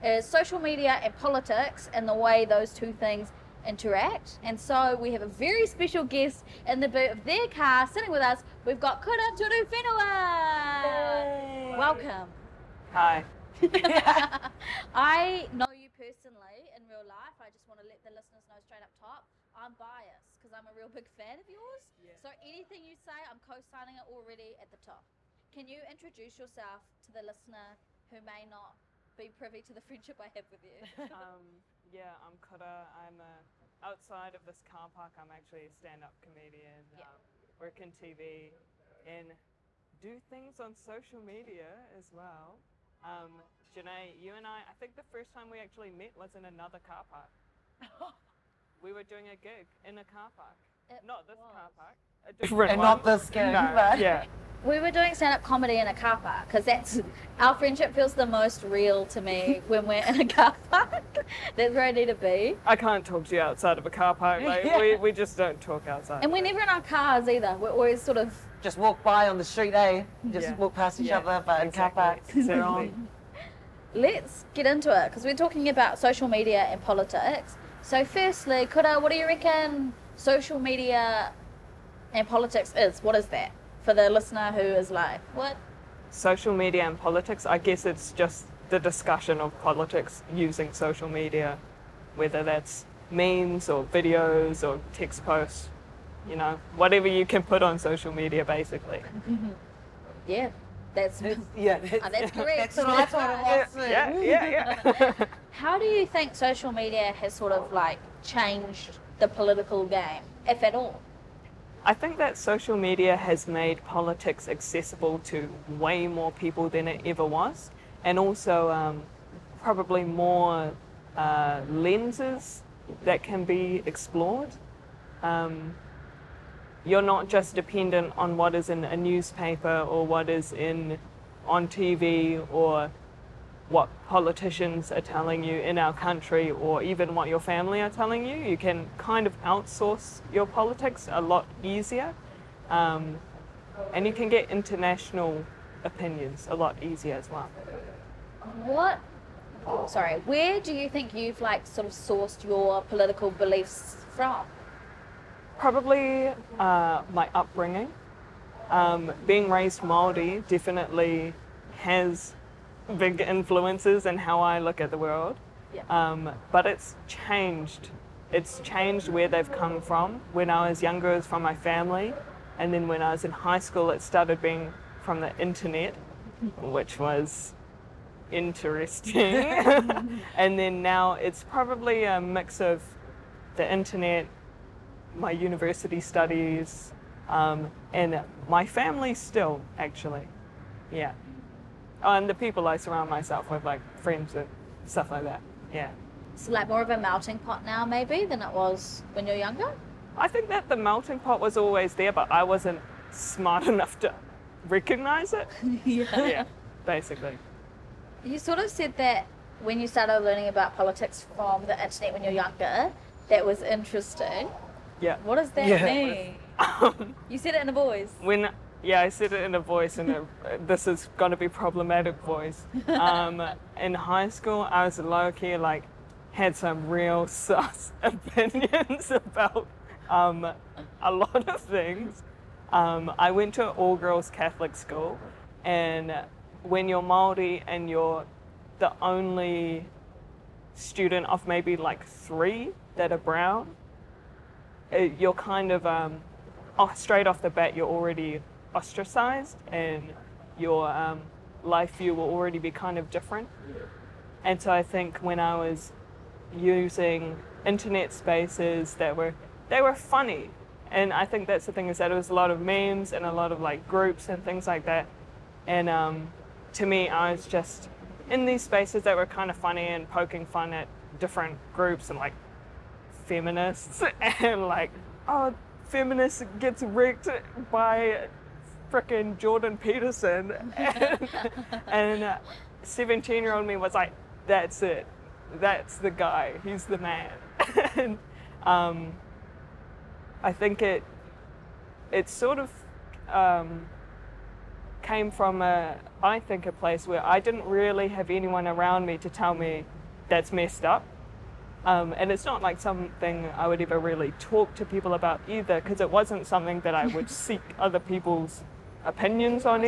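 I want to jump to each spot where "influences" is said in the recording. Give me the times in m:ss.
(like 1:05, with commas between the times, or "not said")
2:43.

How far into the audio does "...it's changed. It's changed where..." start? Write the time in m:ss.
2:46.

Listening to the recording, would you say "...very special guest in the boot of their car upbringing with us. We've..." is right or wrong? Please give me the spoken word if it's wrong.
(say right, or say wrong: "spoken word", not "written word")
wrong: "sitting", not "upbringing".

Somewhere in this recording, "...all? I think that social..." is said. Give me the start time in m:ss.
1:50.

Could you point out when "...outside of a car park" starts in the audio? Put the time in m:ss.
1:03.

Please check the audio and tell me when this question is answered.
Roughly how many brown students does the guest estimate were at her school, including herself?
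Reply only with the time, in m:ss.
4:02.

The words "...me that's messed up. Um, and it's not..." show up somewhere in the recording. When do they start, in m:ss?
4:59.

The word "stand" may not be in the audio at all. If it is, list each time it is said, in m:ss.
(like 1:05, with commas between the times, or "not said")
0:35, 0:55.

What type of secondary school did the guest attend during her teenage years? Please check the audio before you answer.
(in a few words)
all girls Catholic school.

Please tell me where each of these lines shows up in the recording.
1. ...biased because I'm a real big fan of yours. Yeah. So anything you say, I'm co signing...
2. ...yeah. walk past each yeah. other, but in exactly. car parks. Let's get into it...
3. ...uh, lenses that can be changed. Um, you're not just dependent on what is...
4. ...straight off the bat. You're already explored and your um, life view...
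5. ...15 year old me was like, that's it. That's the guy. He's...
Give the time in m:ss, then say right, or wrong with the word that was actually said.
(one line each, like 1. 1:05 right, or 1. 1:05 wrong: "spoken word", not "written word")
1. 0:19 right
2. 1:10 right
3. 2:01 wrong: "explored", not "changed"
4. 4:06 wrong: "ostracized", not "explored"
5. 4:42 wrong: "17", not "15".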